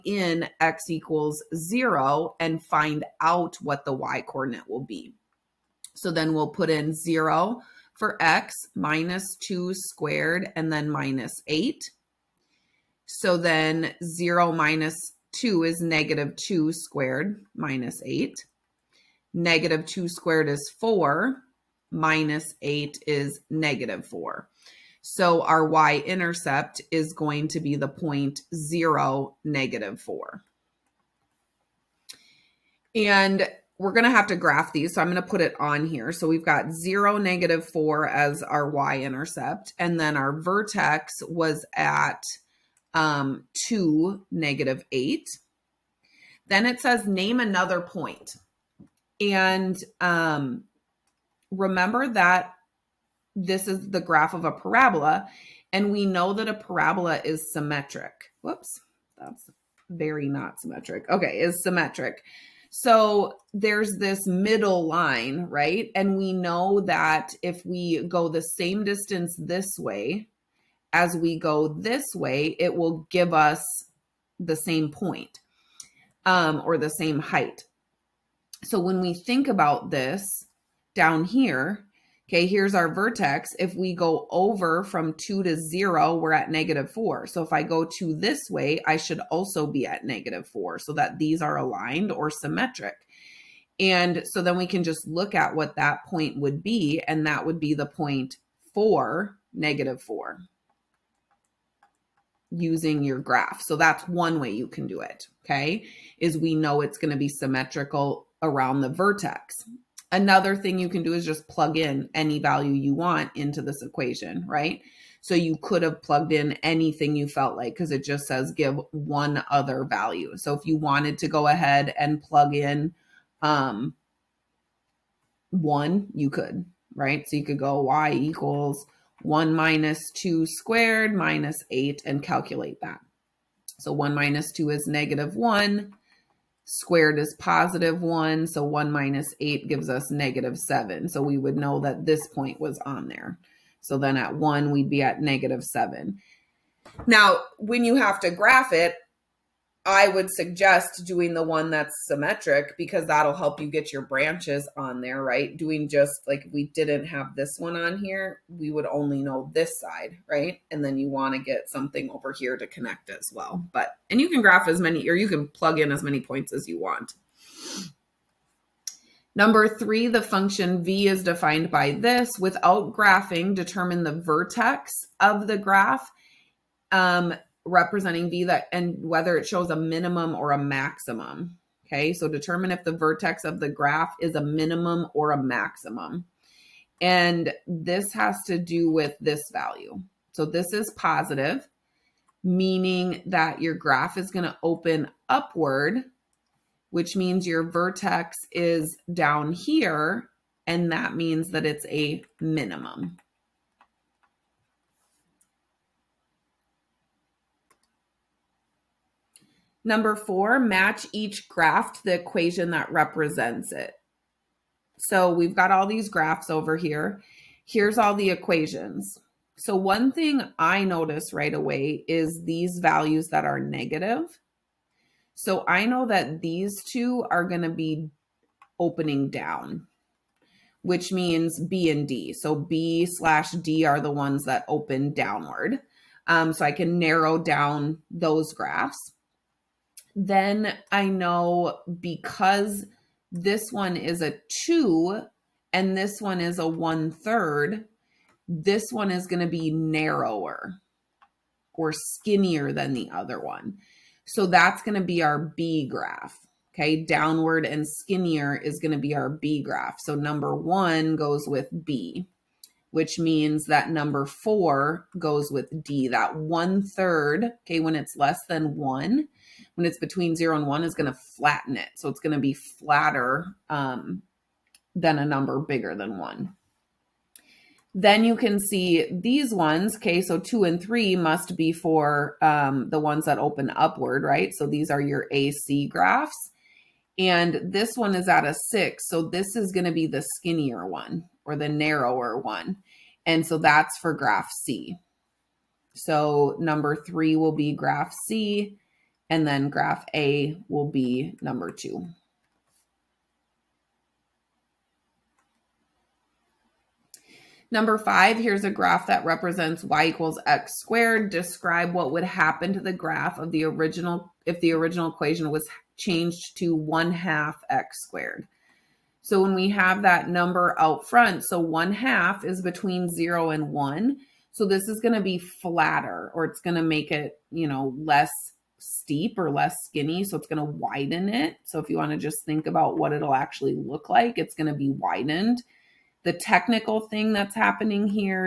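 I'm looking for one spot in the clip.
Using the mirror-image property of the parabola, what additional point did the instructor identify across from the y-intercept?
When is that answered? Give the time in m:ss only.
1:38.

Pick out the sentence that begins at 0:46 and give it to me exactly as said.
Then it says name another point.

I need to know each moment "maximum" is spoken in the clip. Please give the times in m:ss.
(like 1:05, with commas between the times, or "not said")
3:00, 3:05.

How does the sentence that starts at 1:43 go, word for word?
So that's one way you can do it, okay, is we know it's going to be symmetrical around the vertex.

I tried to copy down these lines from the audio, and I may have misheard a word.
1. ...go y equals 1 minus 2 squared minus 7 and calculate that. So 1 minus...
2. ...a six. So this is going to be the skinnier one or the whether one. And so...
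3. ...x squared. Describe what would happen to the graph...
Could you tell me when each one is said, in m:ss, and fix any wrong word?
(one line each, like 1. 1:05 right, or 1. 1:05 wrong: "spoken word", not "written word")
1. 2:07 wrong: "8", not "7"
2. 4:48 wrong: "narrower", not "whether"
3. 5:10 right.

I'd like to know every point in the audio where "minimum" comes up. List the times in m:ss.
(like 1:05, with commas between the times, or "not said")
2:59, 3:04, 3:22.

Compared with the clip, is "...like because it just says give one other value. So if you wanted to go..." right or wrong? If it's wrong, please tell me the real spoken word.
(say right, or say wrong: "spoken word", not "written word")
right.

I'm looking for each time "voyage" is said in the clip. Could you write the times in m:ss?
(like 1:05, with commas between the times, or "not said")
not said.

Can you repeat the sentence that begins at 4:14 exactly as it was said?
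So that's going to be our B graph.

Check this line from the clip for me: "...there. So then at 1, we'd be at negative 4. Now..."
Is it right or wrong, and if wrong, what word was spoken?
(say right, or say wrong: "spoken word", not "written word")
wrong: "7", not "4".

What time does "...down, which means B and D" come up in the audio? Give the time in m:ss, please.
3:49.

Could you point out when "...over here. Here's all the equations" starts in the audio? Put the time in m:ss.
3:36.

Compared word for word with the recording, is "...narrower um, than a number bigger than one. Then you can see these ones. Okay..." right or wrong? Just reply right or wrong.
wrong.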